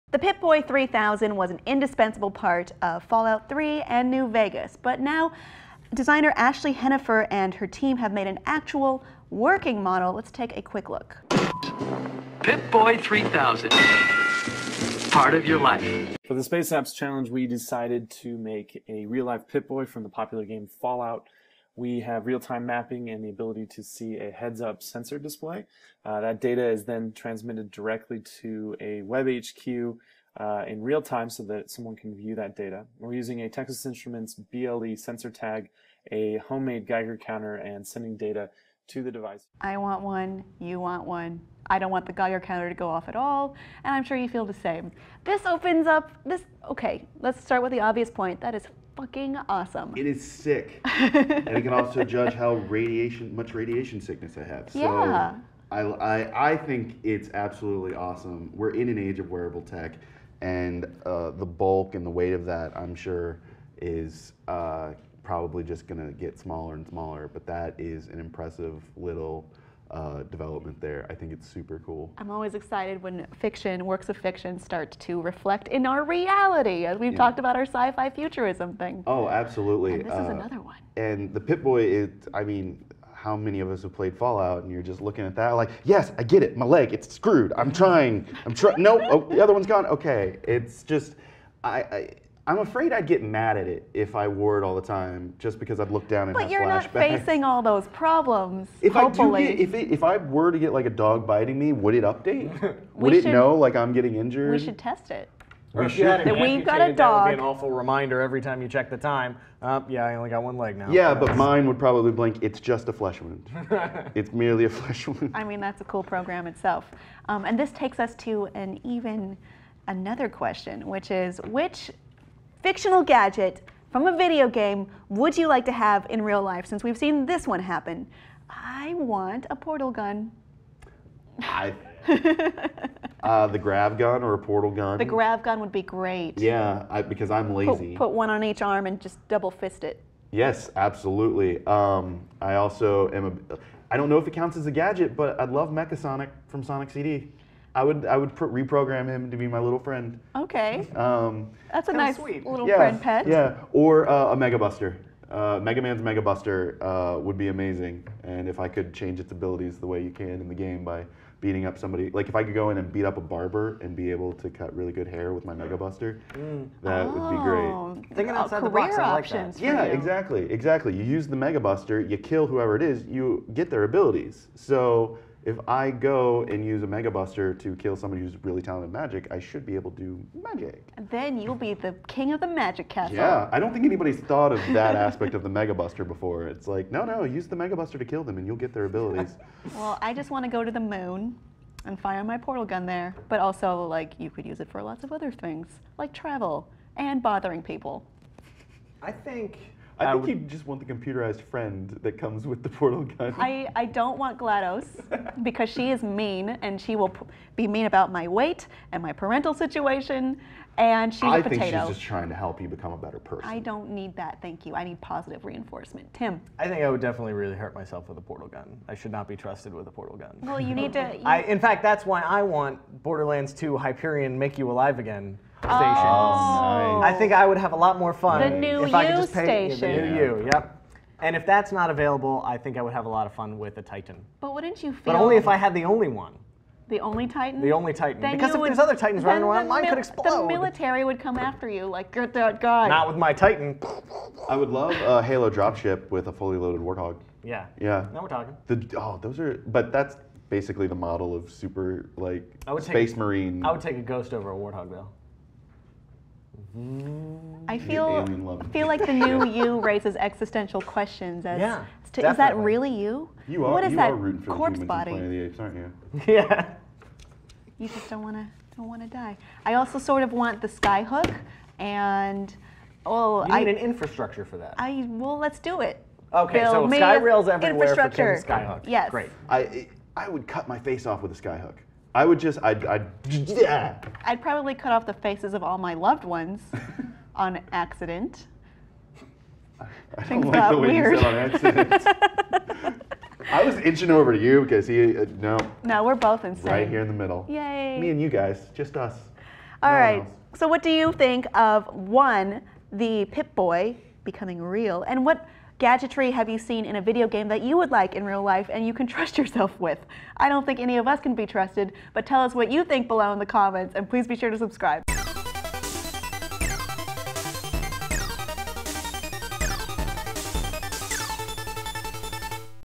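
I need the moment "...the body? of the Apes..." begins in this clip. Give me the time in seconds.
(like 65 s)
264 s.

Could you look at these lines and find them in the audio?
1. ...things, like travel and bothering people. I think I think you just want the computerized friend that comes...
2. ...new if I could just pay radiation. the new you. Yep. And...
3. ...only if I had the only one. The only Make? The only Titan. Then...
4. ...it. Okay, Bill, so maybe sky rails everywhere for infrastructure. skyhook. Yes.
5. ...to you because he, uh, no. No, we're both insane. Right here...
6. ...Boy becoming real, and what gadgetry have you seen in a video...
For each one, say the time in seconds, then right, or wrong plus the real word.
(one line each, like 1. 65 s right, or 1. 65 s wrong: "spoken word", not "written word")
1. 195 s right
2. 228 s wrong: "station", not "radiation"
3. 235 s wrong: "Titan", not "Make"
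4. 275 s right
5. 294 s right
6. 303 s right.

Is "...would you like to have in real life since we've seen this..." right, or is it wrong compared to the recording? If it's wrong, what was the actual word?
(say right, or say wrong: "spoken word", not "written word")
right.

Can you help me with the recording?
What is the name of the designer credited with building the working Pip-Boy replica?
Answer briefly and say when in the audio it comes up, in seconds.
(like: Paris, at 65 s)
Ashley Hennefer, at 6 s.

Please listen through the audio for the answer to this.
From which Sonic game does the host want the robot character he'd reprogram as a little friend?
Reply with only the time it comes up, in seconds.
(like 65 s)
146 s.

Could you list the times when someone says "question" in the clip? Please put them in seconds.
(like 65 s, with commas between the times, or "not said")
120 s, 260 s.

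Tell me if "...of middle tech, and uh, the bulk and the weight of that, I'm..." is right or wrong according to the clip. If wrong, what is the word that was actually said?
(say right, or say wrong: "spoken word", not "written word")
wrong: "wearable", not "middle".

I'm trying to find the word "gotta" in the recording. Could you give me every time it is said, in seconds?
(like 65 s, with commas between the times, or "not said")
not said.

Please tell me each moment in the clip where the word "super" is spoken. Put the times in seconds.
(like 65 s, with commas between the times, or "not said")
71 s, 251 s.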